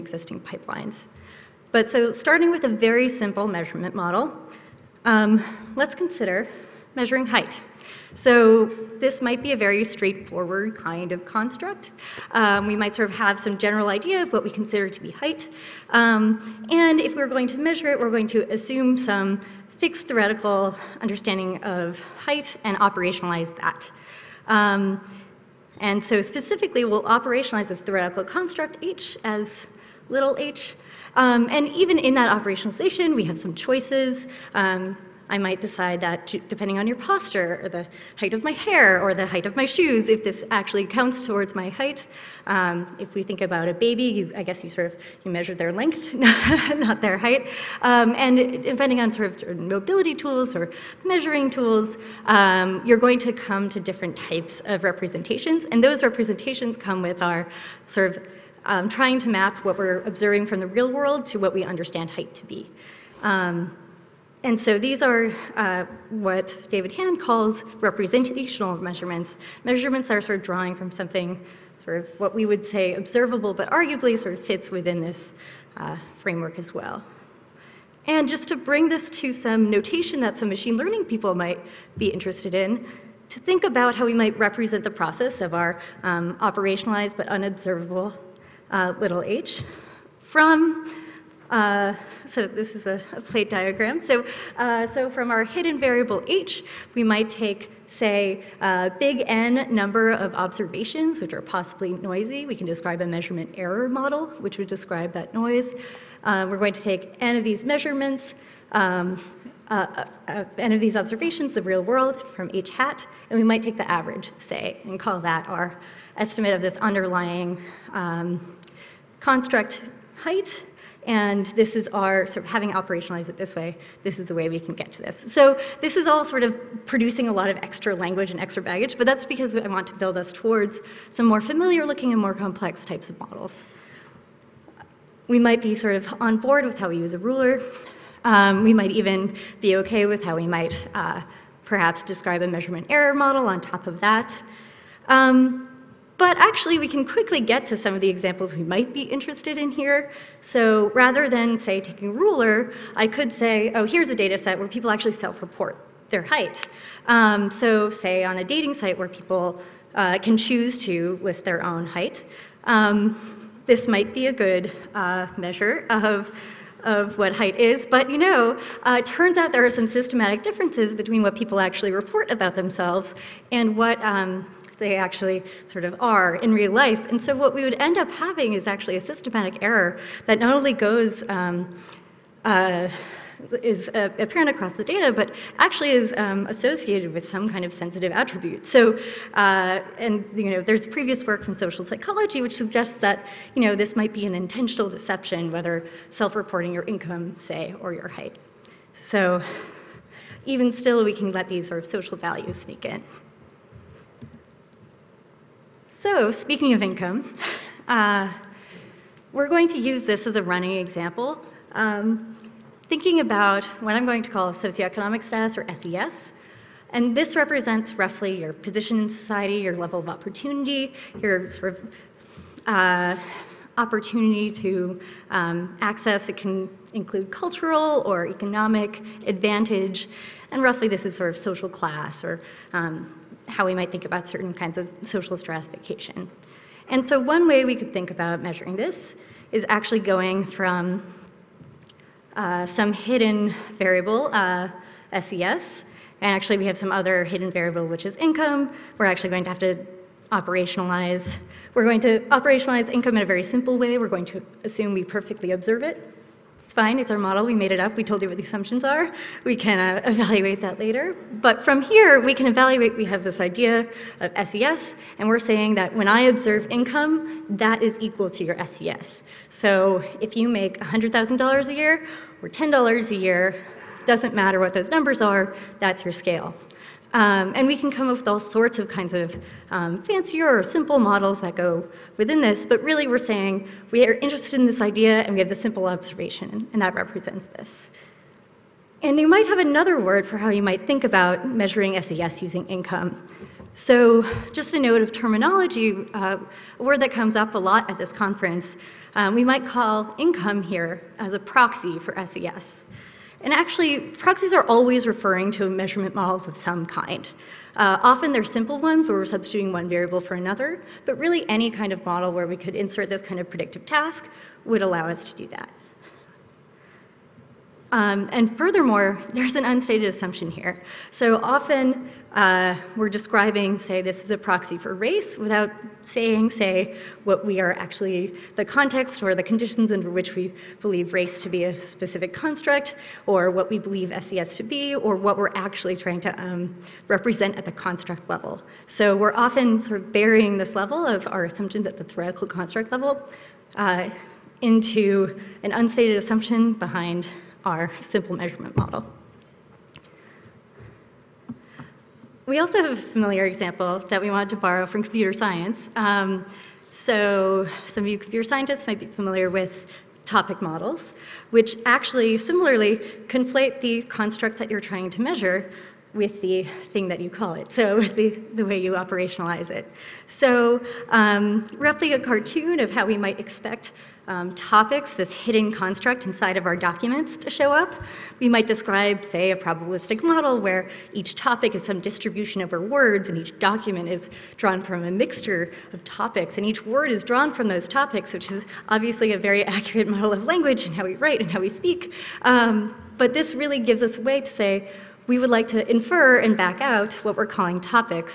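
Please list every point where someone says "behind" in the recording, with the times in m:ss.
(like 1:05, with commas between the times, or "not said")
5:46.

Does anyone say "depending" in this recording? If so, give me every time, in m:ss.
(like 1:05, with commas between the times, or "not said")
0:36, 0:48.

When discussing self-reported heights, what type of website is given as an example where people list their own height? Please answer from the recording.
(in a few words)
Dating site.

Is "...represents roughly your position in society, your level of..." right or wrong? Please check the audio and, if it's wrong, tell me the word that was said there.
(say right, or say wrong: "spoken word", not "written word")
right.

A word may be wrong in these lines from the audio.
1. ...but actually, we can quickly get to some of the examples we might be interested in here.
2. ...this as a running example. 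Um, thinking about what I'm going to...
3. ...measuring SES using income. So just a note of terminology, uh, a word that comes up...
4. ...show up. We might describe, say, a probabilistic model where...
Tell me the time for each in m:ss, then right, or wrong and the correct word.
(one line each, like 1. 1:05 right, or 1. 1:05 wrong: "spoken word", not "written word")
1. 2:26 right
2. 3:30 right
3. 4:51 right
4. 6:17 right.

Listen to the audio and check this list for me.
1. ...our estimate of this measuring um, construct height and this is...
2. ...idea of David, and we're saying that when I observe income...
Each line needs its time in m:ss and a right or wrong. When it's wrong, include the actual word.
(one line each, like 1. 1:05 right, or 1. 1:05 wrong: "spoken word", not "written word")
1. 1:55 wrong: "underlying", not "measuring"
2. 4:23 wrong: "SES", not "David".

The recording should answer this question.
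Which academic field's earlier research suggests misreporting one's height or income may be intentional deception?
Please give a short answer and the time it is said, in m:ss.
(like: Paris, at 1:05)
Social psychology, at 3:11.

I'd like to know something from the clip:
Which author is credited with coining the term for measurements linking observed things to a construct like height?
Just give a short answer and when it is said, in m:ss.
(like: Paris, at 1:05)
David Hand, at 1:06.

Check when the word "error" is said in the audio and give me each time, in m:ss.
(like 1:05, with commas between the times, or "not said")
1:43, 2:22, 2:59.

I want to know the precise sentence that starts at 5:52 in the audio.
we also have a familiar example that we wanted to borrow from computer science.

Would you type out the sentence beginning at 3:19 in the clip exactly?
So, even still, we can let these sort of social values sneak in.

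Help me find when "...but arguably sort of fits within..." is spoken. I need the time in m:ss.
1:13.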